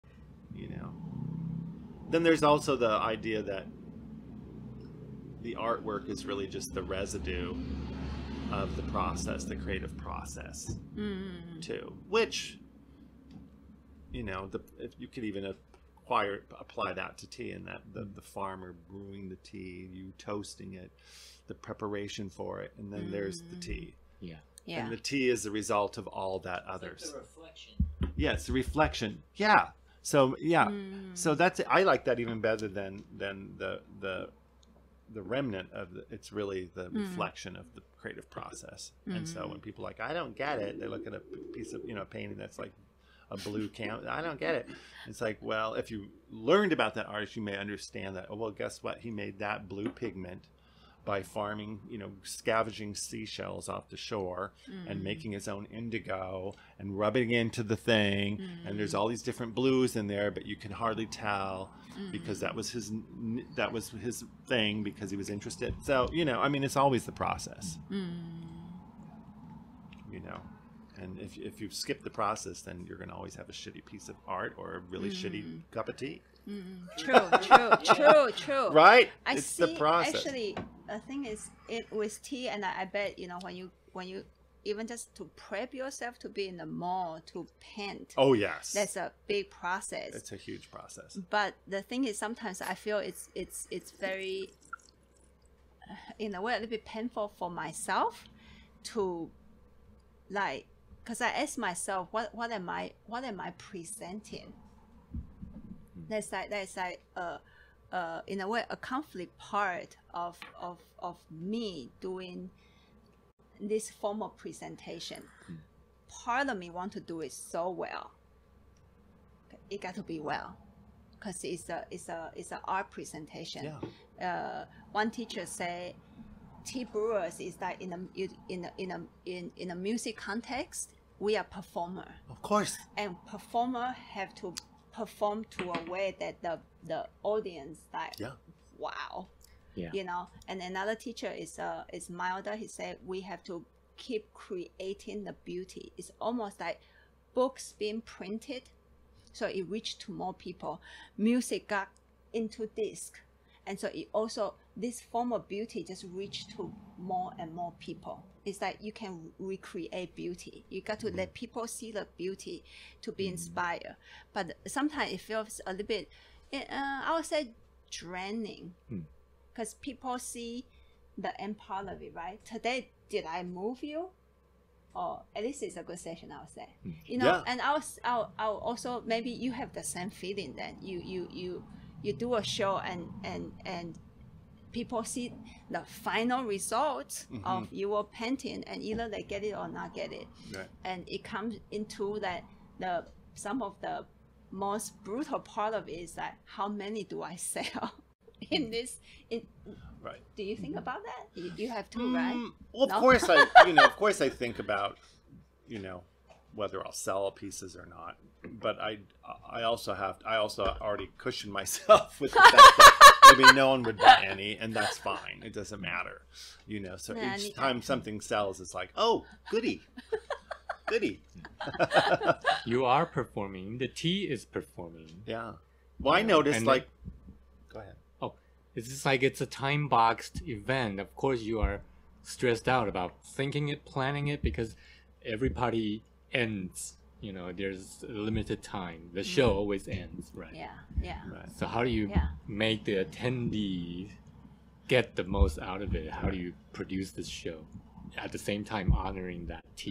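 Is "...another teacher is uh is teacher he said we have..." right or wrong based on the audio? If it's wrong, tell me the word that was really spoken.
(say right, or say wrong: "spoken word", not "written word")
wrong: "milder", not "teacher".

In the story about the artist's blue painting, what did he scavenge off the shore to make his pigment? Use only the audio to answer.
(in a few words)
Seashells.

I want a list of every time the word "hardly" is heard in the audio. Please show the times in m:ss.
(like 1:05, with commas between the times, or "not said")
1:00.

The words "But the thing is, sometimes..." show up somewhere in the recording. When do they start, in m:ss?
1:31.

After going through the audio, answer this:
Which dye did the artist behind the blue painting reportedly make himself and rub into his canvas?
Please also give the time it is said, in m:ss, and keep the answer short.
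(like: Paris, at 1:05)
Indigo, at 0:55.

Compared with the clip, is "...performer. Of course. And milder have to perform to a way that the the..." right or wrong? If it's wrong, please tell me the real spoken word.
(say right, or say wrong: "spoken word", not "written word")
wrong: "performer", not "milder".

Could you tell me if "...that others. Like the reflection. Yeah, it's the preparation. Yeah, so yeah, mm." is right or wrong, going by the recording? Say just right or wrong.
wrong.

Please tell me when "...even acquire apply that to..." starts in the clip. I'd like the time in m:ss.
0:15.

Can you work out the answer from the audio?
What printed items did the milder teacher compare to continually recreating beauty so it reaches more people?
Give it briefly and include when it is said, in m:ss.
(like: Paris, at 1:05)
Books, at 2:27.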